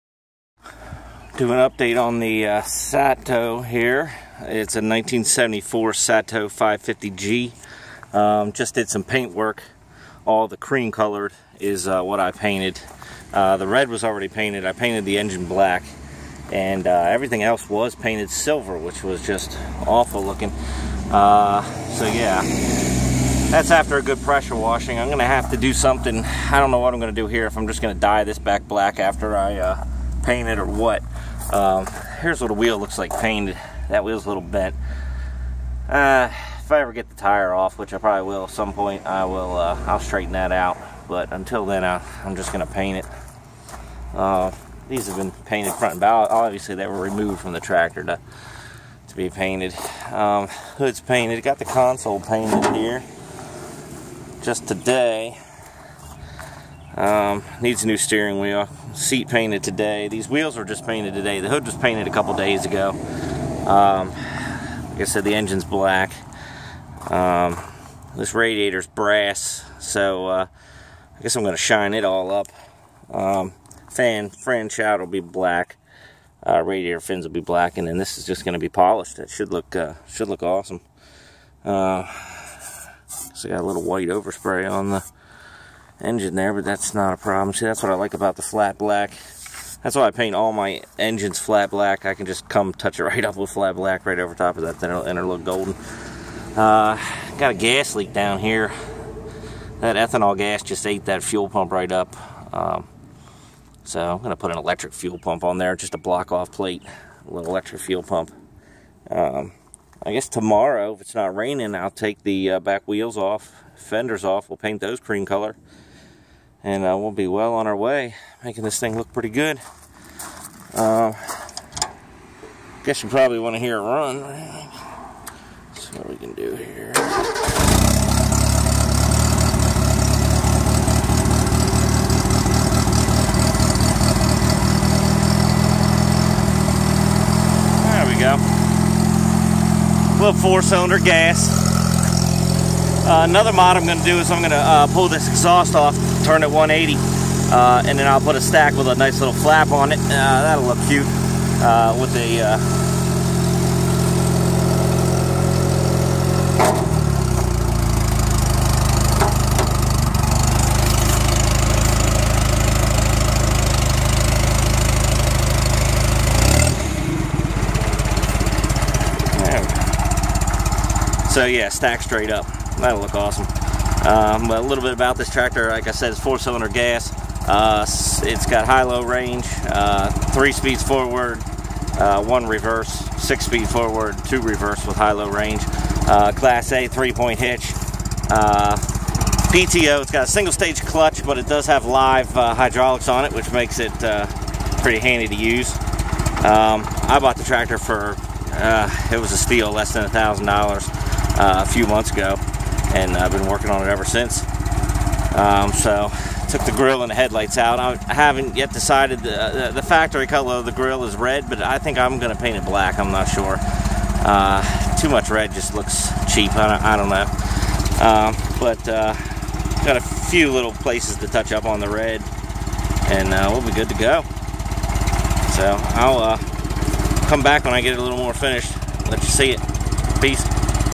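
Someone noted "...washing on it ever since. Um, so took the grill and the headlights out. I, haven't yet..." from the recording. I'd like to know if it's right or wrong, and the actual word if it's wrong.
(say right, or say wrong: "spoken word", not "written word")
wrong: "working", not "washing".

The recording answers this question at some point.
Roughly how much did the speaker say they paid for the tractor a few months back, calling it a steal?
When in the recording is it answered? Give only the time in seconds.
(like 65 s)
199 s.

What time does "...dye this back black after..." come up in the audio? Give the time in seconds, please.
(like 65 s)
27 s.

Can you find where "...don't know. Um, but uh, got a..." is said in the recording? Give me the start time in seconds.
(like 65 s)
216 s.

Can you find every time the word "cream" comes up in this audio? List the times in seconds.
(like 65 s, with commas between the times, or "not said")
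10 s, 114 s.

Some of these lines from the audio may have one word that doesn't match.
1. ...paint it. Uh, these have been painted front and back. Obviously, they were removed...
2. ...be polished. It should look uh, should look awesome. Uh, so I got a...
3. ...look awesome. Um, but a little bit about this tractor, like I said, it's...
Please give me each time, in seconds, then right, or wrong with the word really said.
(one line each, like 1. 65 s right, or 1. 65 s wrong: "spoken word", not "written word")
1. 42 s right
2. 78 s right
3. 172 s right.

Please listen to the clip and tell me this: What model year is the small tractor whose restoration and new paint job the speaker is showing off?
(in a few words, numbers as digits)
1974.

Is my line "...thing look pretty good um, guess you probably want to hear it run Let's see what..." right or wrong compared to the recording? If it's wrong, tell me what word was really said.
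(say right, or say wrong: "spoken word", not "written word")
right.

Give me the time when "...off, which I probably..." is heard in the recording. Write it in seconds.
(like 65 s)
37 s.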